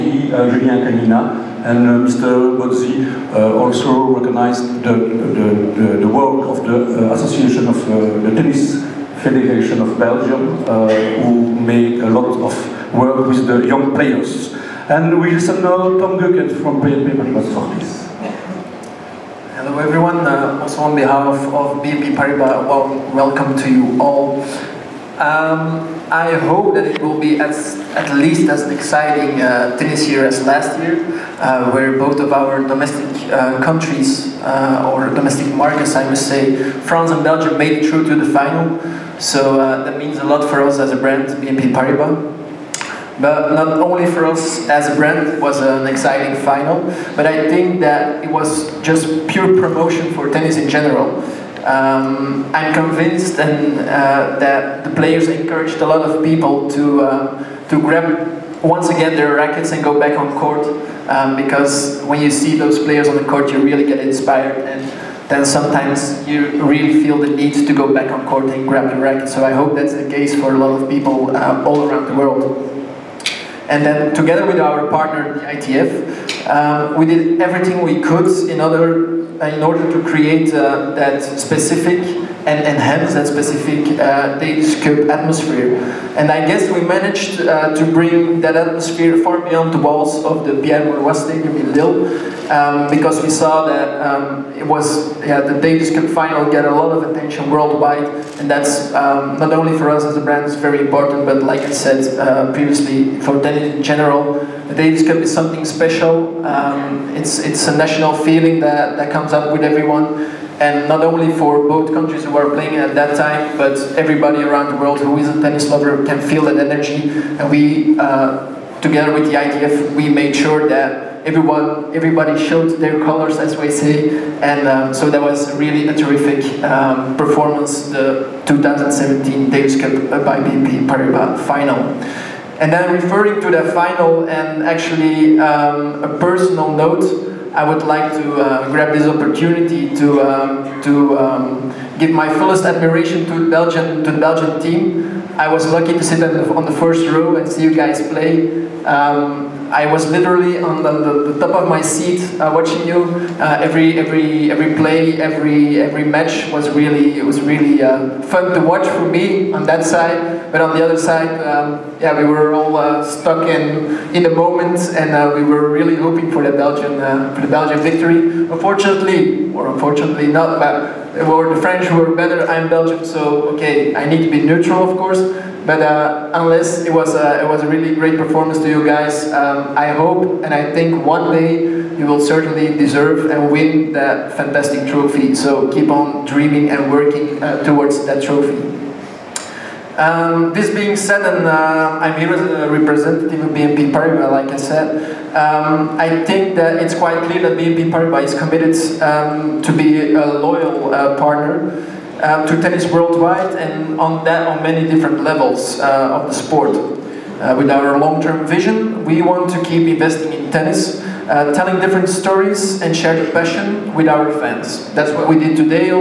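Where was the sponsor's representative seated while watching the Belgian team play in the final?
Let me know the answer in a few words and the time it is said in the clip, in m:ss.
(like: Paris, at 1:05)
first row, at 2:26.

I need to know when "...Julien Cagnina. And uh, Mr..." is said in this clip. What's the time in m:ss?
0:00.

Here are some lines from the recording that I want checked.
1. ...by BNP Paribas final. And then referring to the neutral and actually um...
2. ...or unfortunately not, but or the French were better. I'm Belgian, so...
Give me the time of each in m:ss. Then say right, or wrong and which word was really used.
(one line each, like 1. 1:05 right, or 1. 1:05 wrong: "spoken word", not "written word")
1. 2:10 wrong: "final", not "neutral"
2. 2:49 right.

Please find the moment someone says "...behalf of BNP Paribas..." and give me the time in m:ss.
0:20.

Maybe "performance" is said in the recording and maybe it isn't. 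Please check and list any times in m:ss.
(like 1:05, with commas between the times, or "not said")
2:07, 2:58.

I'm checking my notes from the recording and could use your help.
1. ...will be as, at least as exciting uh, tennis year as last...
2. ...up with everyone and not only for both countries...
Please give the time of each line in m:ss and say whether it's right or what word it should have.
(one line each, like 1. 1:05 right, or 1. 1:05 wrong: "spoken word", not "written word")
1. 0:27 right
2. 1:49 right.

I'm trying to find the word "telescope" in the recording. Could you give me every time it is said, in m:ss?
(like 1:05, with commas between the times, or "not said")
1:24, 1:35, 1:44.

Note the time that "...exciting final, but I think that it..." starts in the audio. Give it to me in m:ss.
0:45.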